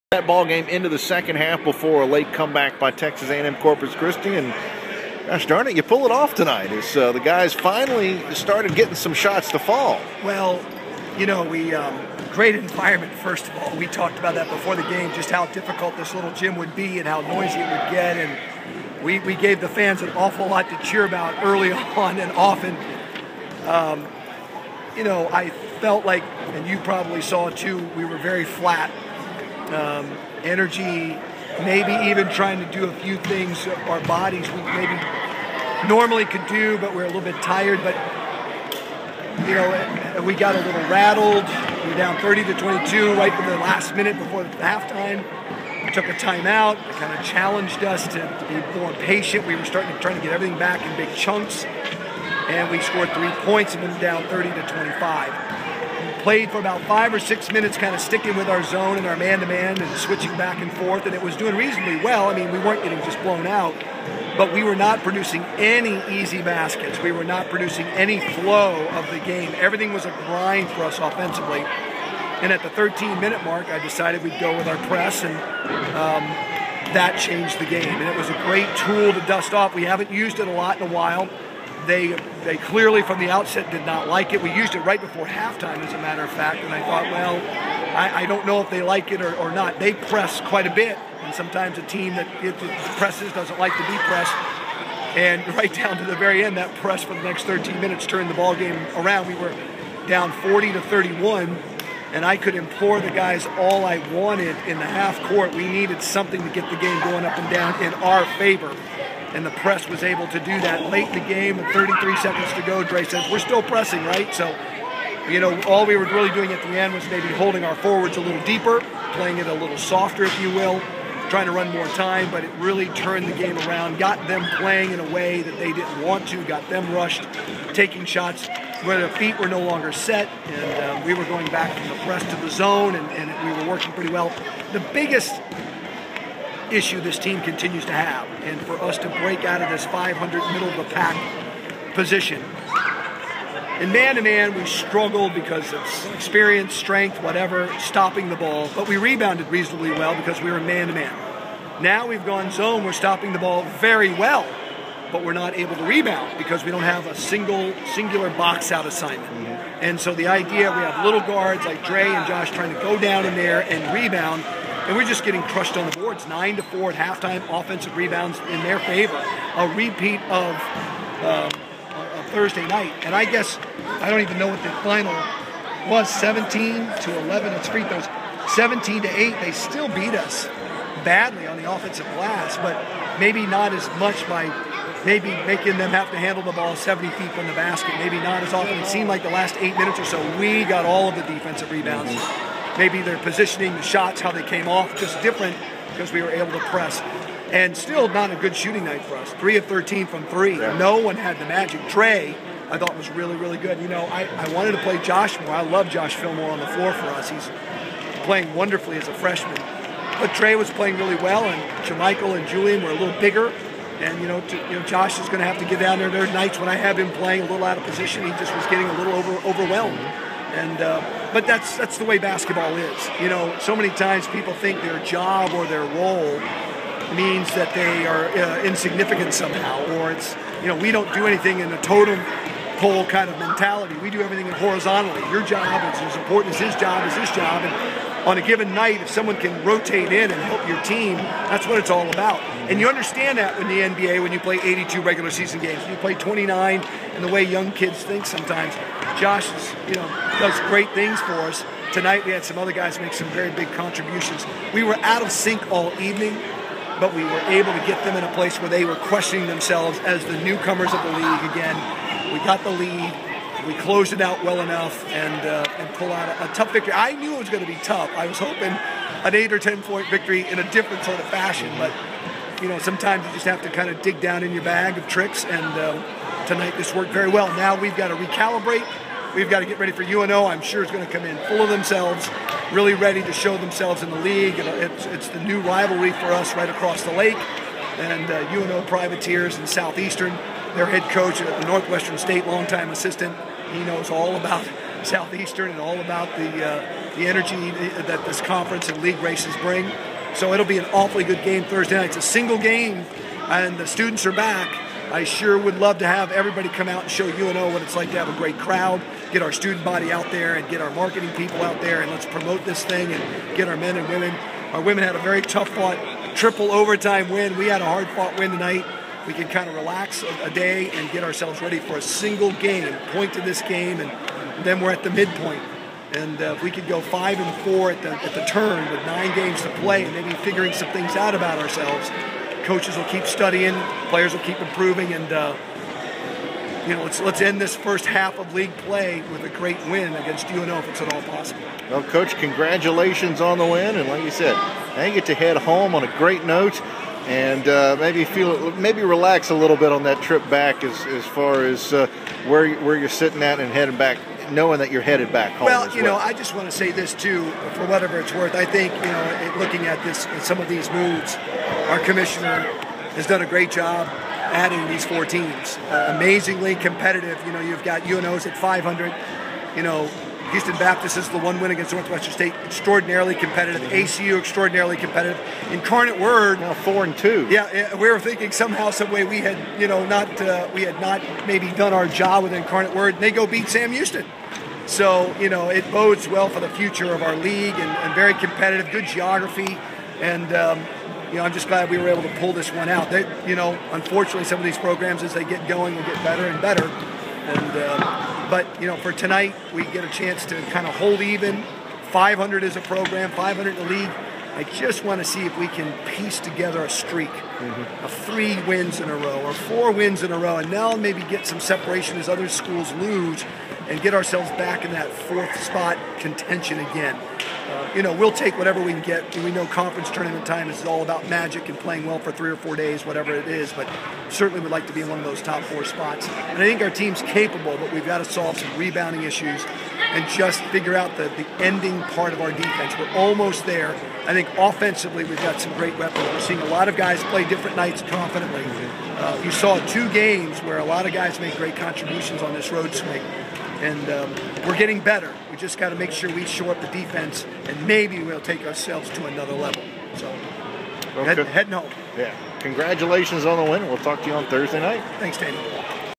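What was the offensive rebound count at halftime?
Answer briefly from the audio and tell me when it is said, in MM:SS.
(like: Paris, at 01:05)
9 to 4, at 02:46.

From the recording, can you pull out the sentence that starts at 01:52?
Dre says, we're still pressing, right?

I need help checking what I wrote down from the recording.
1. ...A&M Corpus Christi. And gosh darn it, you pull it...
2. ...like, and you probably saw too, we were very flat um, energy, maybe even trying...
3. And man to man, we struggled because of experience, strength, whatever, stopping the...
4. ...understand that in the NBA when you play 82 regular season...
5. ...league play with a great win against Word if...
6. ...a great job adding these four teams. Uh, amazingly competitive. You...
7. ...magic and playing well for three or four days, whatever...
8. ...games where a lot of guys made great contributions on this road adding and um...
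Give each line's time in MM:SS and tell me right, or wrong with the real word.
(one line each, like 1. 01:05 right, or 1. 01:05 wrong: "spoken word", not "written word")
1. 00:03 right
2. 00:26 right
3. 02:23 right
4. 04:02 right
5. 05:38 wrong: "UNO", not "Word"
6. 06:03 right
7. 07:01 right
8. 07:20 wrong: "swing", not "adding".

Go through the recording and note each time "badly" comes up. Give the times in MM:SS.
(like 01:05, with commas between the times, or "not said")
03:01.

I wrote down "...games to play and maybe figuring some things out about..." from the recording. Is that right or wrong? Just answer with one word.
right.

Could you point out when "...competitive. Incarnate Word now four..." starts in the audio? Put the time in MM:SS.
06:14.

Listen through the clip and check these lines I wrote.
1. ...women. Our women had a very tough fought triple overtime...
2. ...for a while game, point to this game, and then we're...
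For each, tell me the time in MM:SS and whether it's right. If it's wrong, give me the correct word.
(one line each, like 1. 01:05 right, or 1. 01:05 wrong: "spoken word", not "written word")
1. 05:14 right
2. 05:21 wrong: "single", not "while".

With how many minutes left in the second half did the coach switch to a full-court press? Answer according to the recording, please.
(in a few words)
13 minute mark.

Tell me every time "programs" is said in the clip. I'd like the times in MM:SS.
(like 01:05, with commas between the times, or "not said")
06:34, 06:42.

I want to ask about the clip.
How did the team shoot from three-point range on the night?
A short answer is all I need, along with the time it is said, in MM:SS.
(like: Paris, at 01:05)
3 of 13, at 03:19.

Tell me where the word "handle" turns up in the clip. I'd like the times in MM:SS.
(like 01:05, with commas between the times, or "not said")
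03:06.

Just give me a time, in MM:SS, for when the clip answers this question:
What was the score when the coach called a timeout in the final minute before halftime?
00:42.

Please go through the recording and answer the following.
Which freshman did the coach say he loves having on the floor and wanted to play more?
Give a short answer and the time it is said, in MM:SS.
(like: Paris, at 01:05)
Josh Fillmore, at 03:25.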